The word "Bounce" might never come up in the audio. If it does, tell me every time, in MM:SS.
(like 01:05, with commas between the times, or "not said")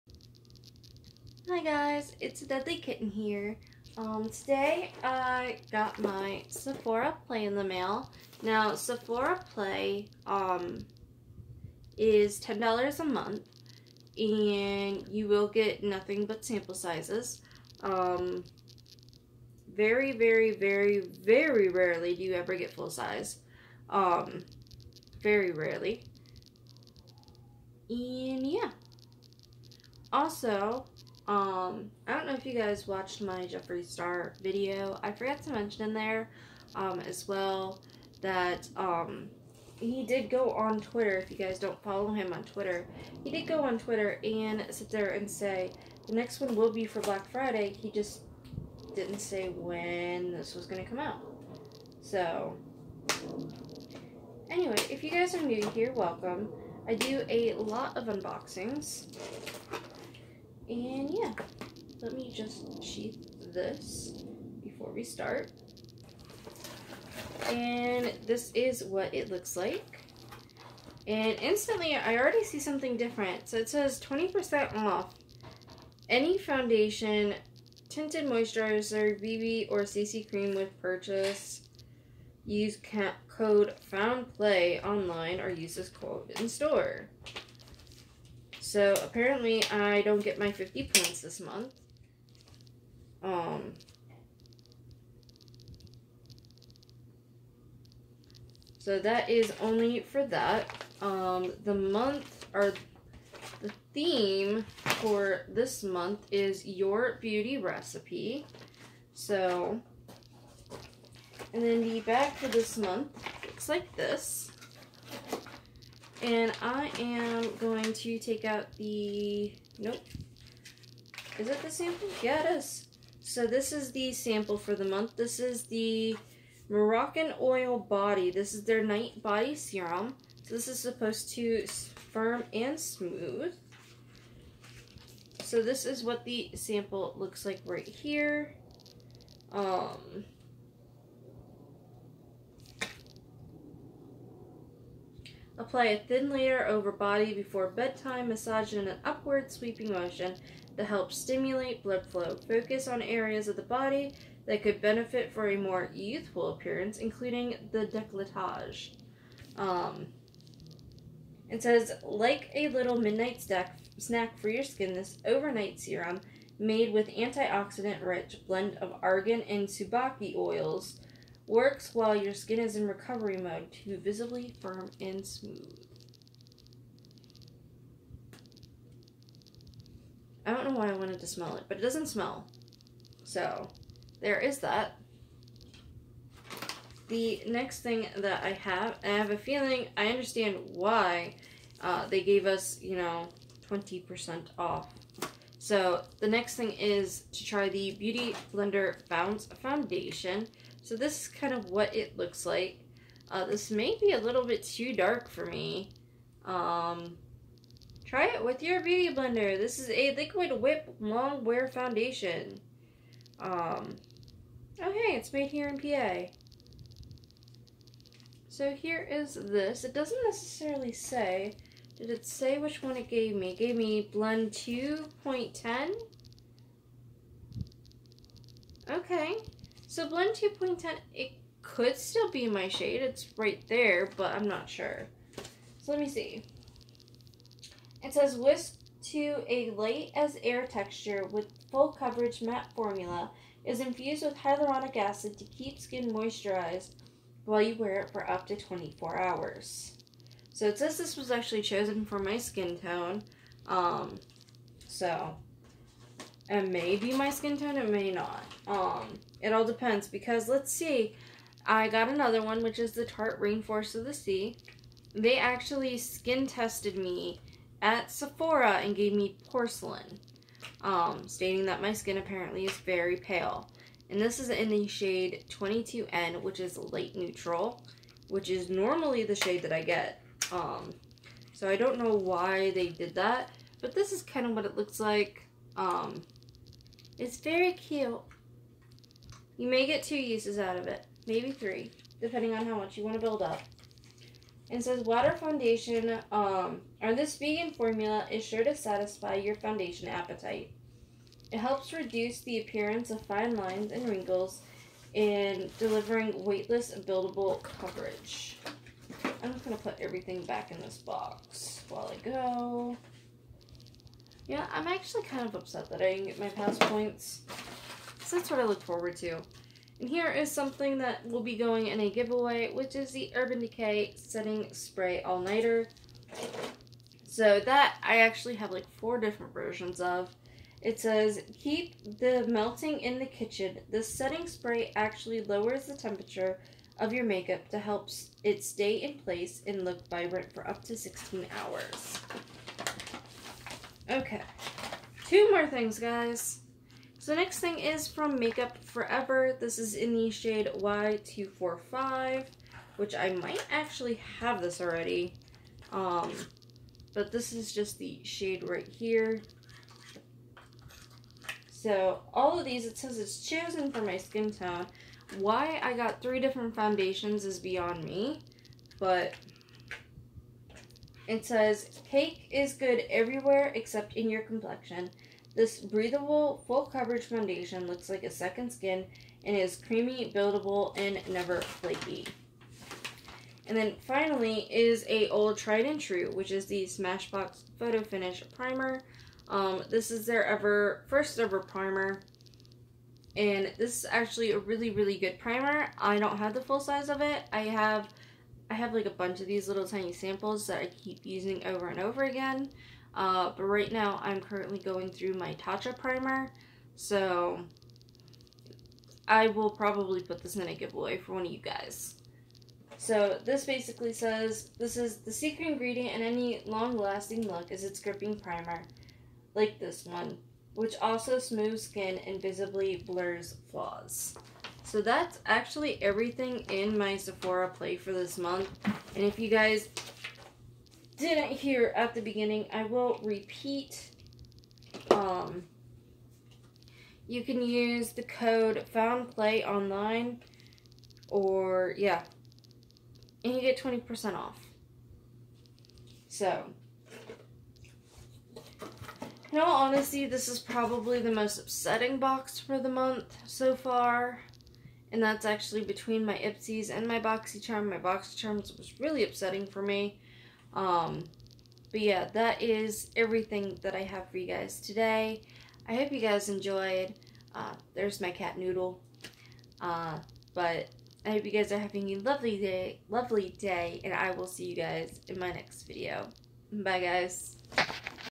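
03:19.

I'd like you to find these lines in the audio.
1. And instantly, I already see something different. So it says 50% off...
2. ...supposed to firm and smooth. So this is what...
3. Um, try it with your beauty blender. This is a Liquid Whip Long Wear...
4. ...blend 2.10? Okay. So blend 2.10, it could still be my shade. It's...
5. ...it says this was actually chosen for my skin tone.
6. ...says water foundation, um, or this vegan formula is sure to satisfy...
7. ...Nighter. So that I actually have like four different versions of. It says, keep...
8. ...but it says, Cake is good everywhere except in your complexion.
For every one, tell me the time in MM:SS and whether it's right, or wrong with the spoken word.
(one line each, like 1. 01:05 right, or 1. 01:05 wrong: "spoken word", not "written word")
1. 01:11 wrong: "20", not "50"
2. 02:10 right
3. 03:26 right
4. 03:44 right
5. 04:10 right
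6. 04:54 right
7. 05:25 right
8. 06:08 right.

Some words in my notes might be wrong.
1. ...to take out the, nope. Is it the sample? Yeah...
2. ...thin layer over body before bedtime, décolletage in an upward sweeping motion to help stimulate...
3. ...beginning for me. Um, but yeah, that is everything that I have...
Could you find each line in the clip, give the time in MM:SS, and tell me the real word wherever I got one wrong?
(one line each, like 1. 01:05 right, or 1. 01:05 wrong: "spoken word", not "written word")
1. 01:57 right
2. 02:26 wrong: "massage", not "décolletage"
3. 07:39 wrong: "upsetting", not "beginning".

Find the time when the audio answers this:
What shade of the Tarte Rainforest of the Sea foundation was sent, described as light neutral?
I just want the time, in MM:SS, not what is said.
04:35.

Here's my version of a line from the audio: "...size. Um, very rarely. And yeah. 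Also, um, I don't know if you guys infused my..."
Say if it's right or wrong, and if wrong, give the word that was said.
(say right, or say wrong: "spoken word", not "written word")
wrong: "watched", not "infused".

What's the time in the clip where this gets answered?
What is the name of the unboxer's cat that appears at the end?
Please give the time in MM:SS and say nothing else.
07:48.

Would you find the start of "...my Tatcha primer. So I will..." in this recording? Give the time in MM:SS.
06:45.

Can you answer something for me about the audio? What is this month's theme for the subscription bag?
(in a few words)
your beauty recipe.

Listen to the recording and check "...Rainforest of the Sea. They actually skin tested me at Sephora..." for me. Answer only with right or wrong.
right.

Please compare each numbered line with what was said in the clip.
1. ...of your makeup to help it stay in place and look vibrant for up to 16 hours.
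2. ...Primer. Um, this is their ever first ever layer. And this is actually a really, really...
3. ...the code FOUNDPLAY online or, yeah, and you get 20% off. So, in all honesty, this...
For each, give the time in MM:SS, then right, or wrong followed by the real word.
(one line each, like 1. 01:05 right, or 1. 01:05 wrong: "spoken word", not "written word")
1. 05:36 right
2. 06:28 wrong: "primer", not "layer"
3. 07:18 right.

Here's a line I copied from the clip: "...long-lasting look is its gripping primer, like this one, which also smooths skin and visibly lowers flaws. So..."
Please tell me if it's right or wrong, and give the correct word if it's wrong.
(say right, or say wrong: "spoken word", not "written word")
wrong: "blurs", not "lowers".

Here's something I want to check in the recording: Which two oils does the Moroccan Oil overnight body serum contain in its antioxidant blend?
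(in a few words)
argan and tsubaki.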